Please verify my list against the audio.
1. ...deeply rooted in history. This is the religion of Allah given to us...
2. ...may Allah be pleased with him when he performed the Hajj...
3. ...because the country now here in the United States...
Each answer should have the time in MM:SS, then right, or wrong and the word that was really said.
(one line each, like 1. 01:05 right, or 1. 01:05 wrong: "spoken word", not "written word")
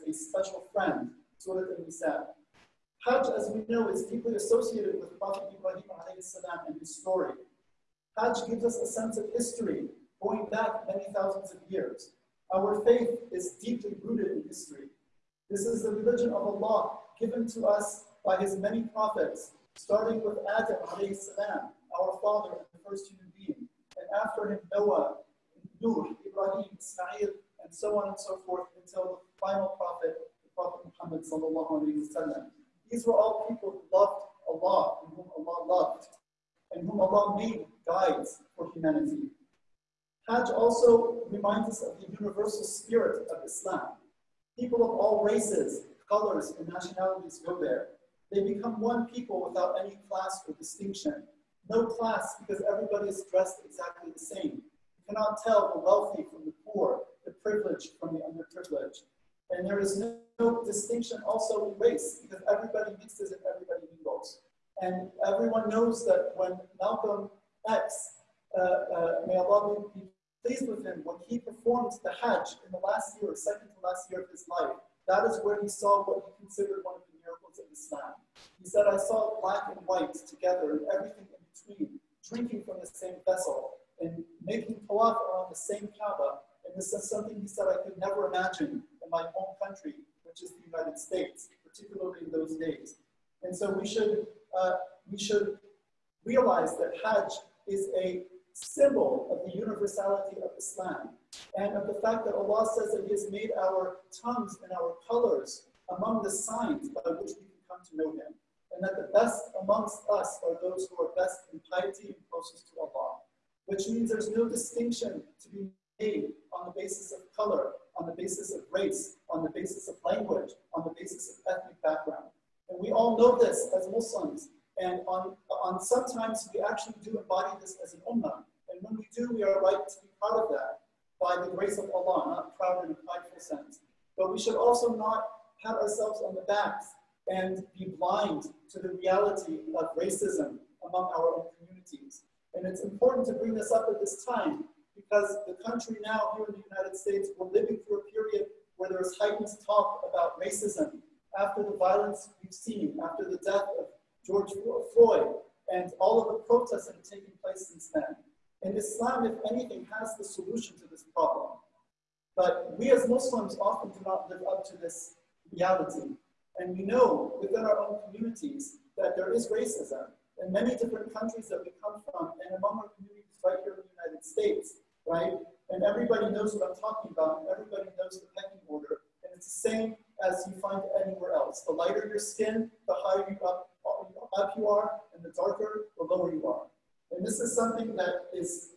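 1. 00:13 right
2. 01:09 right
3. 02:24 right.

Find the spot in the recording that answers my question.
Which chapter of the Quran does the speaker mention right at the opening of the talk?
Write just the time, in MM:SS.
00:01.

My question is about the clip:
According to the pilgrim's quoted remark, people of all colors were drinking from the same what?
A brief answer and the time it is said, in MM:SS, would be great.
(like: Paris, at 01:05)
vessel, at 01:23.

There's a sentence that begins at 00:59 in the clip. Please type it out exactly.
And there is no, no distinction also in race because everybody mixes and everybody mingles.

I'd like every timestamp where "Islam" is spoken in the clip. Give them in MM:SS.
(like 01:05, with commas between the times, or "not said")
00:43, 01:17, 01:40, 02:38.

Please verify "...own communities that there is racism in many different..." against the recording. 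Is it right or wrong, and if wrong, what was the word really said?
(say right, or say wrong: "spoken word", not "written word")
right.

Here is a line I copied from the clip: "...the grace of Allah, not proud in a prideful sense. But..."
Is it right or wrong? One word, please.
right.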